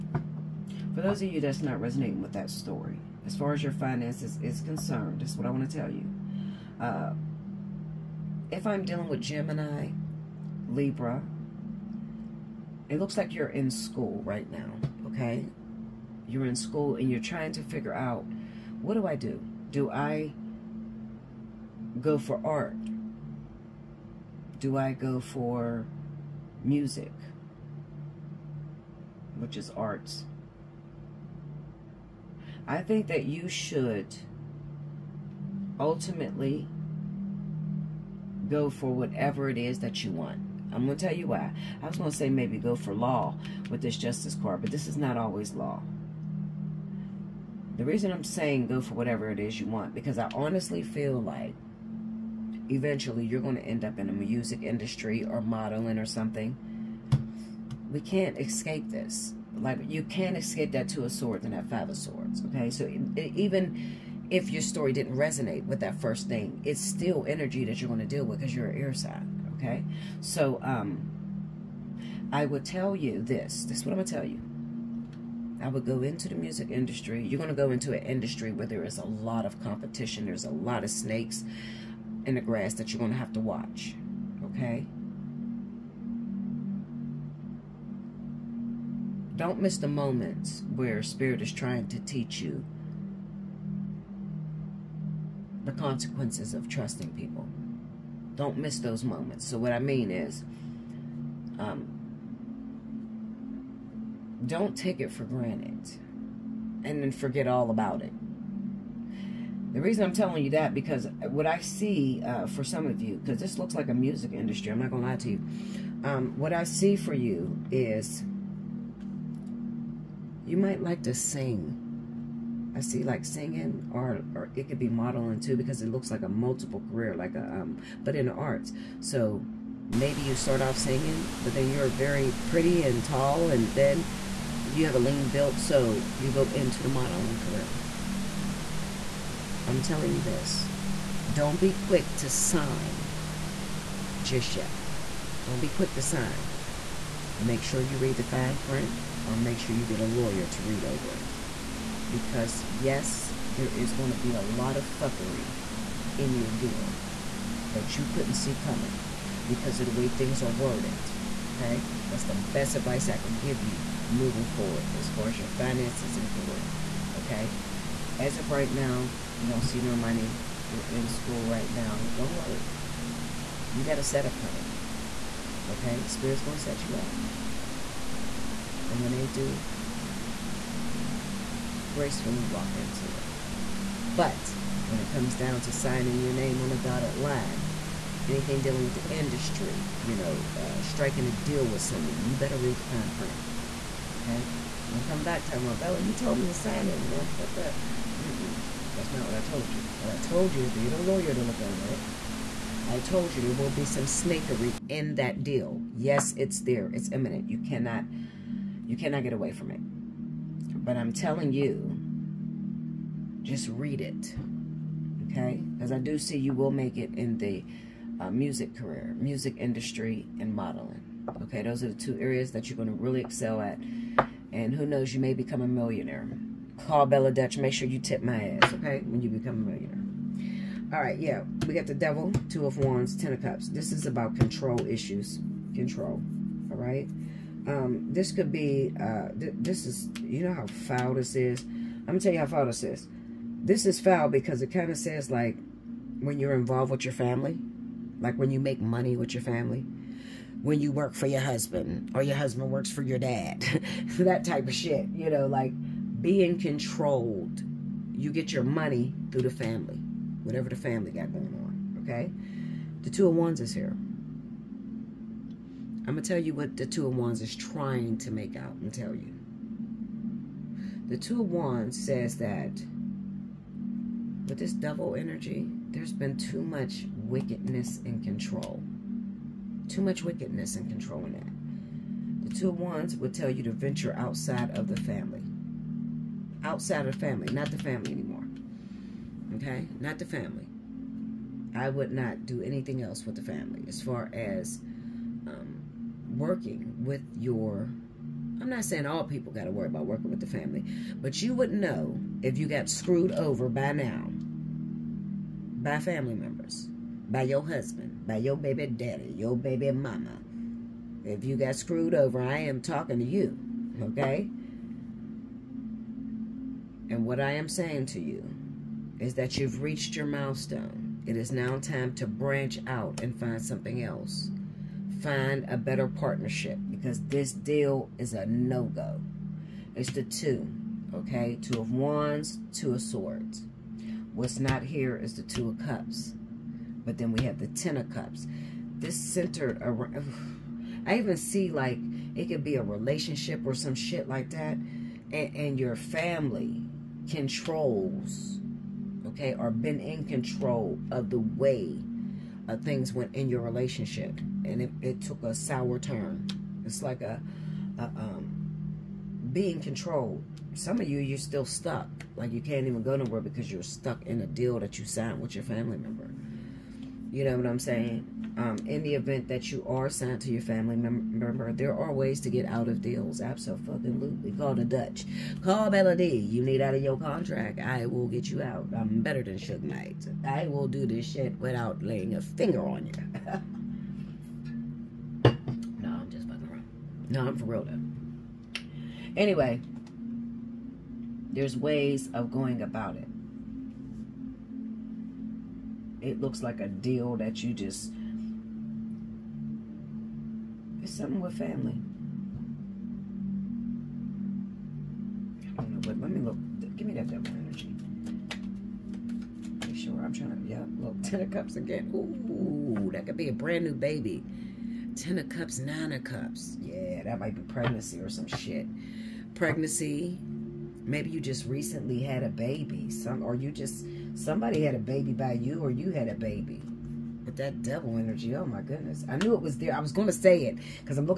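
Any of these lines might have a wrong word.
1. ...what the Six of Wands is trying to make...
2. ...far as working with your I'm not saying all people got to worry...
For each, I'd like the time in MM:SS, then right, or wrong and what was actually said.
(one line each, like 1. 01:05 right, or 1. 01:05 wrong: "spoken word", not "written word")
1. 04:26 wrong: "Two", not "Six"
2. 04:54 right.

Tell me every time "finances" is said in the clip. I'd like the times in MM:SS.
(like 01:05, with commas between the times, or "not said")
00:03, 02:45.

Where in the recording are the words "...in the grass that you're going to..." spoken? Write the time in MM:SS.
01:22.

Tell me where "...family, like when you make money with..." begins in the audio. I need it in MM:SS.
04:07.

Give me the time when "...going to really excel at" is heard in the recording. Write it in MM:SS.
03:42.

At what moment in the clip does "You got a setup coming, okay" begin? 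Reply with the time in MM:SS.
02:53.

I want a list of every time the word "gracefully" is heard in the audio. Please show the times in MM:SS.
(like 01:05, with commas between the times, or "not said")
03:01.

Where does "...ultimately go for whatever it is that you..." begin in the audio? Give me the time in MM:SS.
00:35.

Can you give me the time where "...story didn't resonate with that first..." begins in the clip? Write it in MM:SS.
01:04.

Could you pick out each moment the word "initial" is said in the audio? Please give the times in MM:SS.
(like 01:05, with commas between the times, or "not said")
not said.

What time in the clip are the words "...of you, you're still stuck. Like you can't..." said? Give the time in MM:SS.
06:01.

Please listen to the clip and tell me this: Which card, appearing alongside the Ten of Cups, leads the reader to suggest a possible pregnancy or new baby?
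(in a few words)
Nine of Cups.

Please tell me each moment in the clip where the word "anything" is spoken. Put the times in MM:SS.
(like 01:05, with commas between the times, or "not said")
03:08, 04:52.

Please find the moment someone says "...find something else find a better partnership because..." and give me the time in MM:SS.
05:23.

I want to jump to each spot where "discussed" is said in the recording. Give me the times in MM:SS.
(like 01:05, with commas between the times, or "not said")
not said.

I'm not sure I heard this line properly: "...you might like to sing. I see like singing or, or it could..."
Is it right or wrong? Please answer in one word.
right.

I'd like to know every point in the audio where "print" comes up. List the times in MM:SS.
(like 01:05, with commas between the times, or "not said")
02:28, 03:13.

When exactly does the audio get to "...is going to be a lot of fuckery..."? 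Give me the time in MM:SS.
02:33.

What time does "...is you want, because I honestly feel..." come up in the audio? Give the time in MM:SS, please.
00:49.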